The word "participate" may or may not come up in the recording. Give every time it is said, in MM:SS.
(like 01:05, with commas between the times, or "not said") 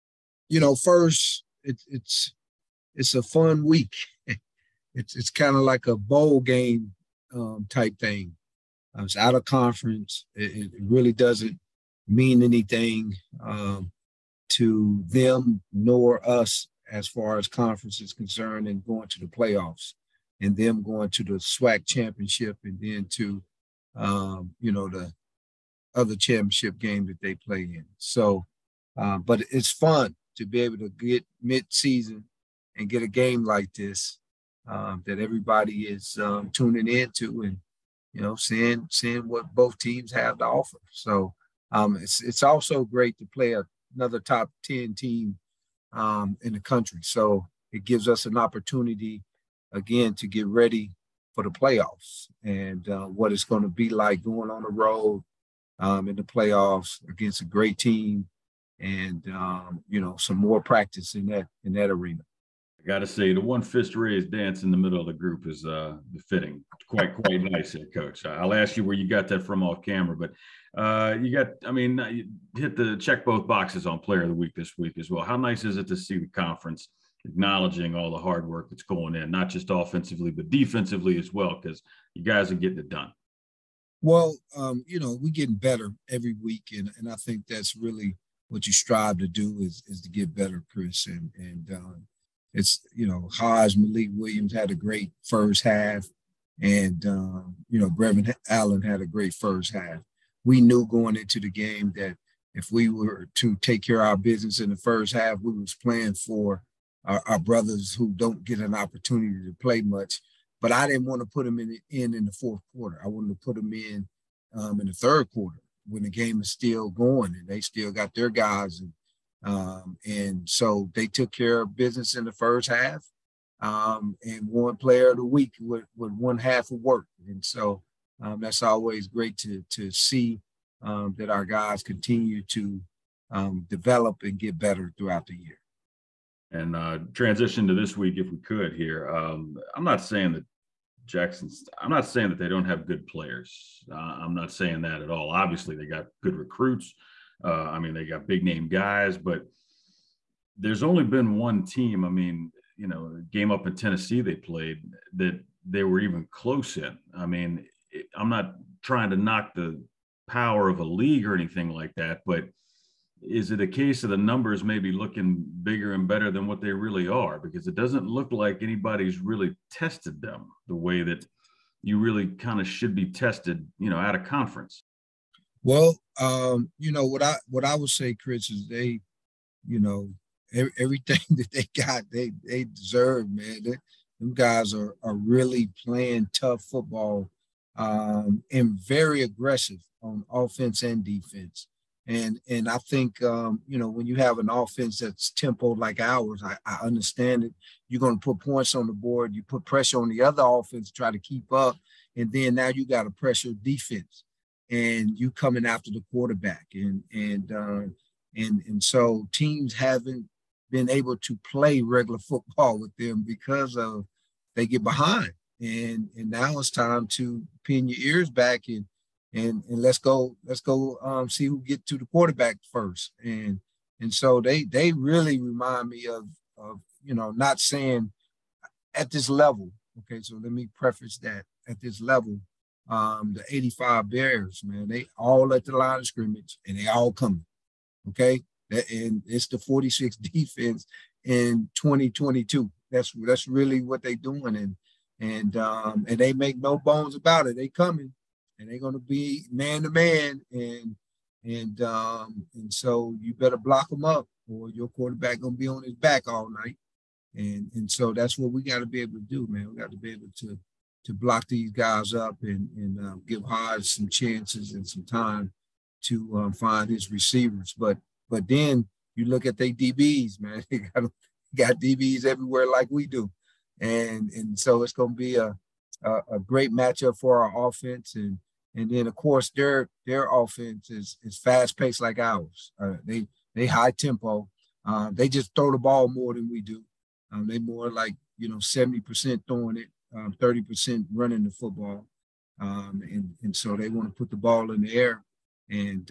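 not said.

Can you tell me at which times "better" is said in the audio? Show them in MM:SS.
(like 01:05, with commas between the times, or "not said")
01:25, 01:30, 02:14, 02:46, 04:13.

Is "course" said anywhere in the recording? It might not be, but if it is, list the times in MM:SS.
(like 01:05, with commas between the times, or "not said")
04:39.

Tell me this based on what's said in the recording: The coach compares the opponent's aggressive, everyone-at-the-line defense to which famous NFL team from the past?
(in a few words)
the 85 Bears.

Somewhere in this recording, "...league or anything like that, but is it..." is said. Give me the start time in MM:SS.
02:40.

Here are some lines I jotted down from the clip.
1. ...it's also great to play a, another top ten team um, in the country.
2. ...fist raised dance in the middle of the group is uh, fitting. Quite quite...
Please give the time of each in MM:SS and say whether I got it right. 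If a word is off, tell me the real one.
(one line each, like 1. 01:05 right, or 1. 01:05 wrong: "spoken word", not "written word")
1. 00:42 right
2. 01:03 right.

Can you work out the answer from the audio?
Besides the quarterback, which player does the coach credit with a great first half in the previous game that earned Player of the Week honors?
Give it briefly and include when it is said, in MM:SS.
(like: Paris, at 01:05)
Brevin Allen, at 01:37.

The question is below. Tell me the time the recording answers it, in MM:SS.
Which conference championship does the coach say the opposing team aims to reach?
00:21.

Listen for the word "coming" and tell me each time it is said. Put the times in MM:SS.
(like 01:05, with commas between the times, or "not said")
03:25, 03:57, 04:07.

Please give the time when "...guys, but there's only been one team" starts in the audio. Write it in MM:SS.
02:28.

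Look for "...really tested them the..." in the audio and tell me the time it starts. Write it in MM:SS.
02:49.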